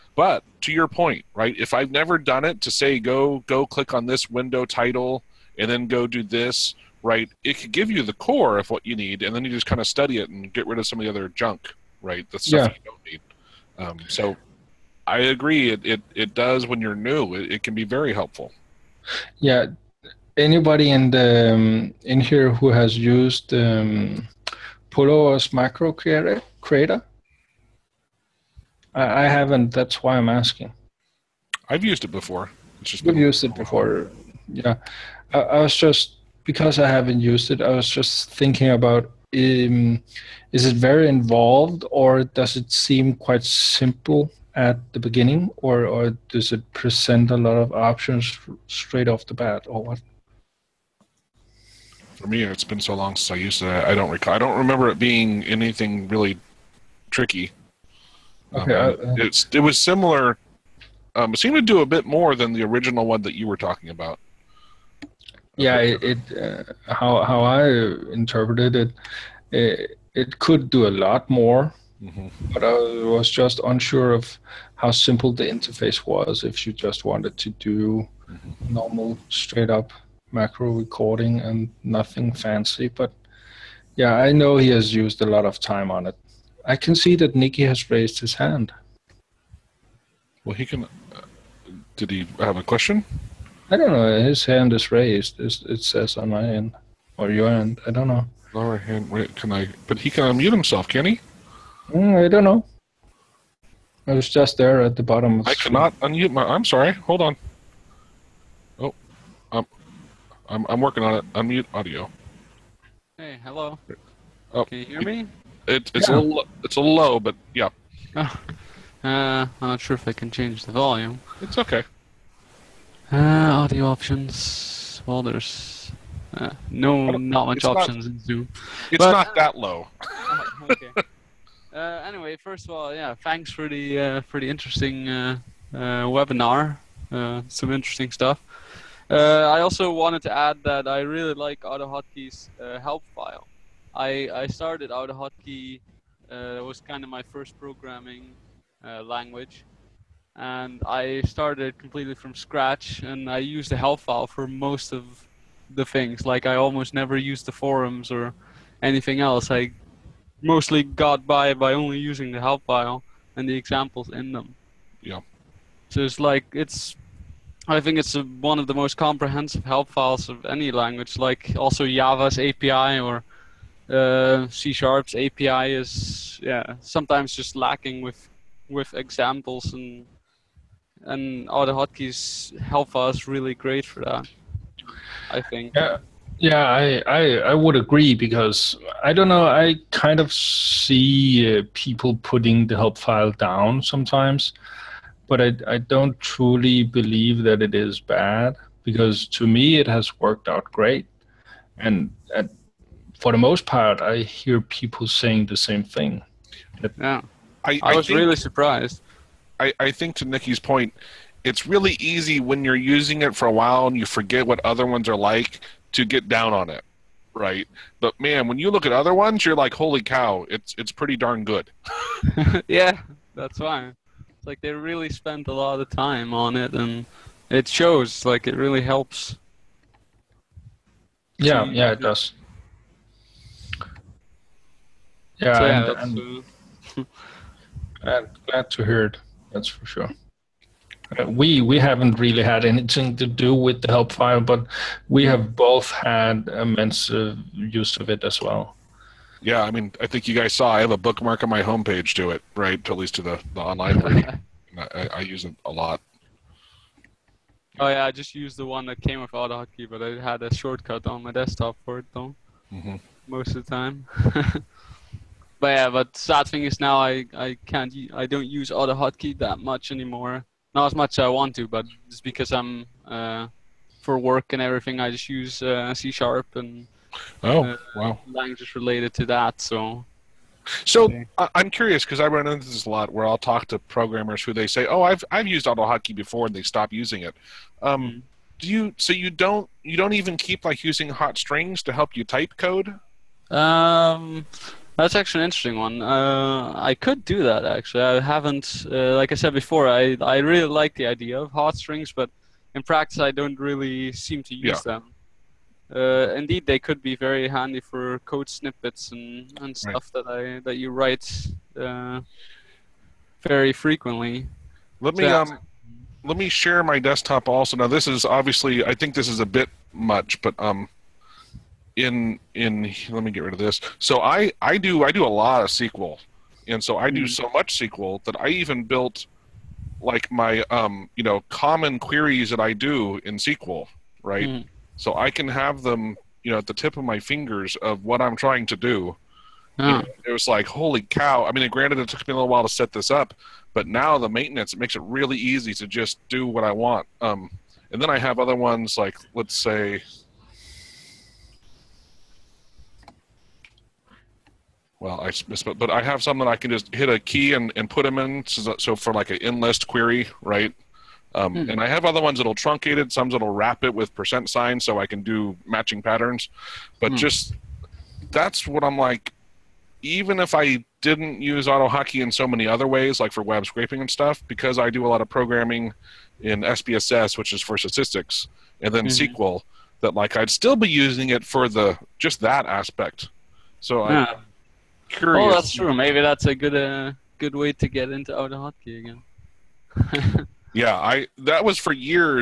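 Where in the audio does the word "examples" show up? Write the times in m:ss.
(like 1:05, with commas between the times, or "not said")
2:43, 2:58.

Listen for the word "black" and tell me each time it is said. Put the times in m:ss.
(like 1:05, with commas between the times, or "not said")
not said.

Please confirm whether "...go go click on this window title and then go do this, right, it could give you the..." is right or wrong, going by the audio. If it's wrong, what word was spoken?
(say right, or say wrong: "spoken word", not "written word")
right.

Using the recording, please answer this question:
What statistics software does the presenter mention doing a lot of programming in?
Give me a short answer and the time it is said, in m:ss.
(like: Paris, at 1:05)
SPSS, at 6:16.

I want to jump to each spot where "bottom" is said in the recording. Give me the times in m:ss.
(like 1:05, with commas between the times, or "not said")
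1:45.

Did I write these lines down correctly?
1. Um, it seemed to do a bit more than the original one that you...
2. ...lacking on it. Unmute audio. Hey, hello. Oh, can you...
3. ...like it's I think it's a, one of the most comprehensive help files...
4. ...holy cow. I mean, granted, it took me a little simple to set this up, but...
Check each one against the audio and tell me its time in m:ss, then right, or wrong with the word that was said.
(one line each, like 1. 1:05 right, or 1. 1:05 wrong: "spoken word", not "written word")
1. 1:01 right
2. 1:50 wrong: "working", not "lacking"
3. 2:46 right
4. 5:40 wrong: "while", not "simple".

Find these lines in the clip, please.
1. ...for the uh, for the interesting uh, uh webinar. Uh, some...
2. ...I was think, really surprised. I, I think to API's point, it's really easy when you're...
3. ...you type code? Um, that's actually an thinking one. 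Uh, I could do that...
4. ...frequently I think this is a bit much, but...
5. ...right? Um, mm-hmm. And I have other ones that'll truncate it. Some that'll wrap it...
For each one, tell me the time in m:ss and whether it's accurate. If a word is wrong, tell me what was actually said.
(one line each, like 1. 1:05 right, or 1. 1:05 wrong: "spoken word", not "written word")
1. 2:13 right
2. 3:27 wrong: "Nikki", not "API"
3. 4:52 wrong: "interesting", not "thinking"
4. 5:18 wrong: "obviously", not "frequently"
5. 6:00 right.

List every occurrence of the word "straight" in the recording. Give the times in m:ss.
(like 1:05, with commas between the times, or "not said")
0:48, 1:19.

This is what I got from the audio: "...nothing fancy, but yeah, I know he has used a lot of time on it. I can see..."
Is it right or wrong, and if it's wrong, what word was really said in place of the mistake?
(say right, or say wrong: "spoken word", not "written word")
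right.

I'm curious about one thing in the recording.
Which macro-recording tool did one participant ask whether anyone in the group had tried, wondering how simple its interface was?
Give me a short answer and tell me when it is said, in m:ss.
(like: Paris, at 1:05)
Pulover's Macro Creator, at 0:24.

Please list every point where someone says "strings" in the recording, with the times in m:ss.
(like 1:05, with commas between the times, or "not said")
4:51, 5:01.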